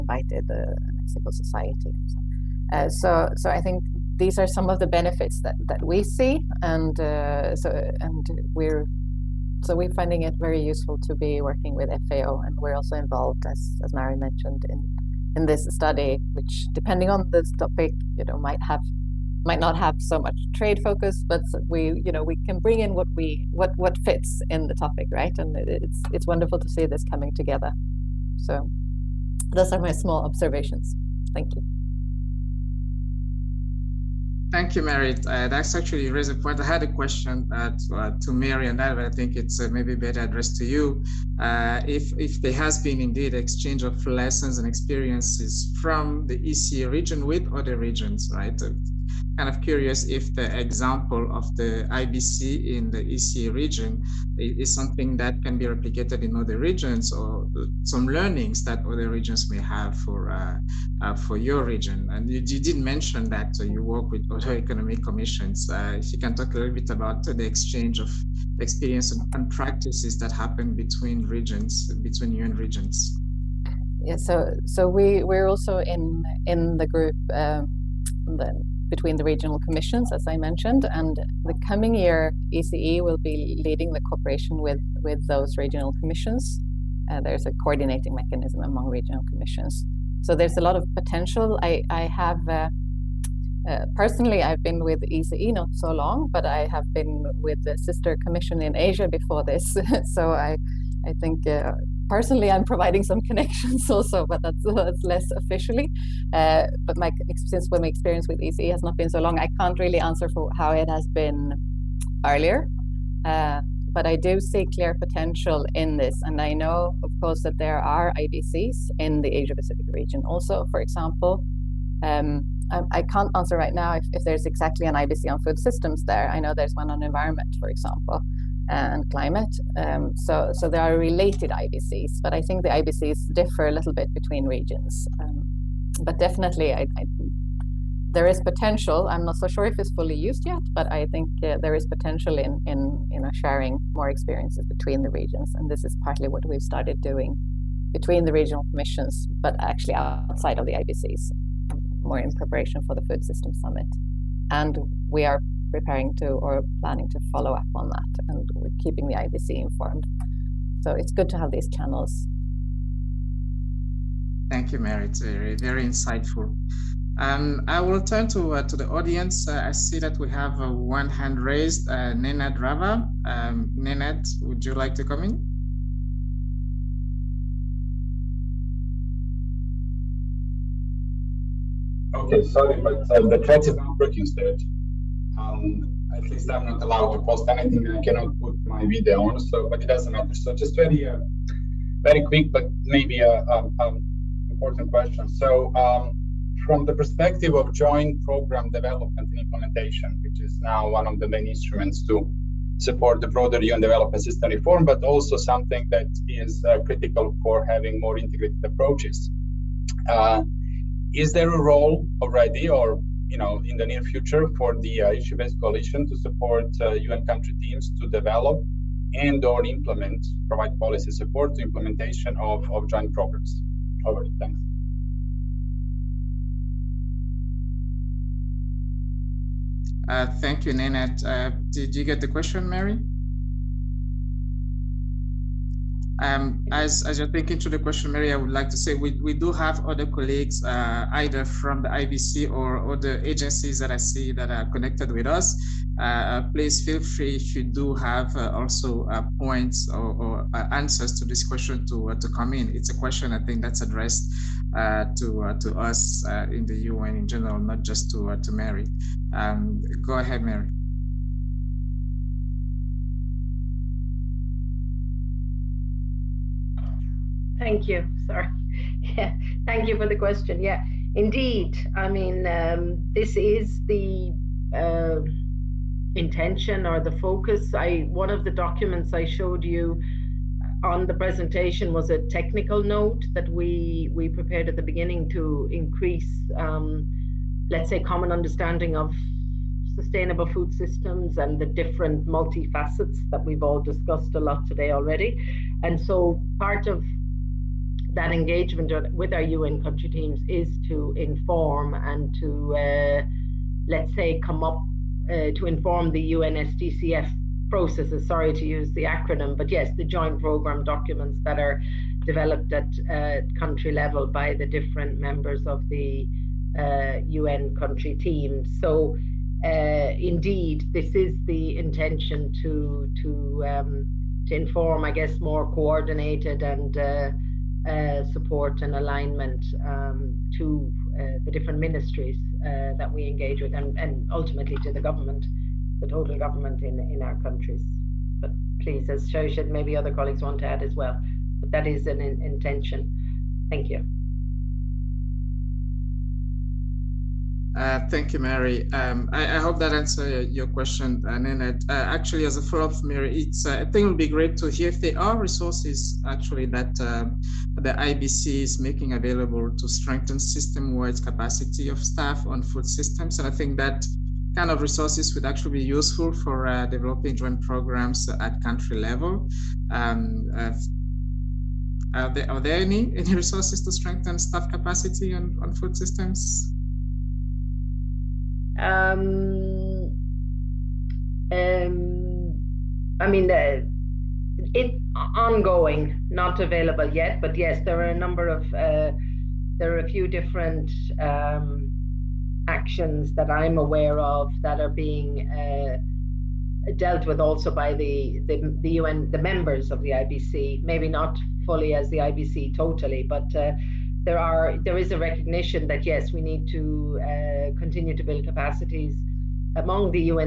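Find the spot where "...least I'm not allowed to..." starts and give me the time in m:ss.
3:06.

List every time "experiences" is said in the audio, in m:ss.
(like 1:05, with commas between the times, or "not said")
0:44, 1:08, 1:47, 2:24.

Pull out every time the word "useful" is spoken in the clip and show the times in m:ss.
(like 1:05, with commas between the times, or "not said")
0:10, 6:05.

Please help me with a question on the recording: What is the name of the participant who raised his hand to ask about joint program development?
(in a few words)
Nenad Rava.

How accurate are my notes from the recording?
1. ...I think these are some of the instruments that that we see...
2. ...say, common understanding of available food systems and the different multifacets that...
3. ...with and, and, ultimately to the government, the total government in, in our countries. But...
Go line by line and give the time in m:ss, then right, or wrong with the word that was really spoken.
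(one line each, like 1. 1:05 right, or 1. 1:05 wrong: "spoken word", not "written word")
1. 0:03 wrong: "benefits", not "instruments"
2. 4:47 wrong: "sustainable", not "available"
3. 5:33 right.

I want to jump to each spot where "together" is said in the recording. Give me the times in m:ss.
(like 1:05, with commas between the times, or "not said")
0:27.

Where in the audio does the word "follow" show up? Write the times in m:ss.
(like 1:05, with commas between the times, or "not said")
2:37, 5:52.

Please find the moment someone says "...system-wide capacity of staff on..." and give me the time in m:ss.
6:00.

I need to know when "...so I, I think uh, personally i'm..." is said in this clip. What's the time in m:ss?
1:40.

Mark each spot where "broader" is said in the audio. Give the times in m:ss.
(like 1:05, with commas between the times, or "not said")
3:23.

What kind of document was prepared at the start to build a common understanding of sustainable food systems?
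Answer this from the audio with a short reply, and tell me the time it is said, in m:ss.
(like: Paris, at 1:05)
a technical note, at 4:42.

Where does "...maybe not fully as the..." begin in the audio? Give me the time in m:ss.
6:40.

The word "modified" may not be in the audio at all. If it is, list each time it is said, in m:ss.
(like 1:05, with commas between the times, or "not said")
not said.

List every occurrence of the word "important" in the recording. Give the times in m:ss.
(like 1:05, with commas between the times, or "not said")
3:14.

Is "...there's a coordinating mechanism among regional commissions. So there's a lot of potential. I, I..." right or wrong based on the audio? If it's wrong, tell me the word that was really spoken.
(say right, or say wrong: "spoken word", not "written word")
right.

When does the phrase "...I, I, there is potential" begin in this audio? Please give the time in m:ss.
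2:16.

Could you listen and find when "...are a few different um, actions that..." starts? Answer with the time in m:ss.
6:29.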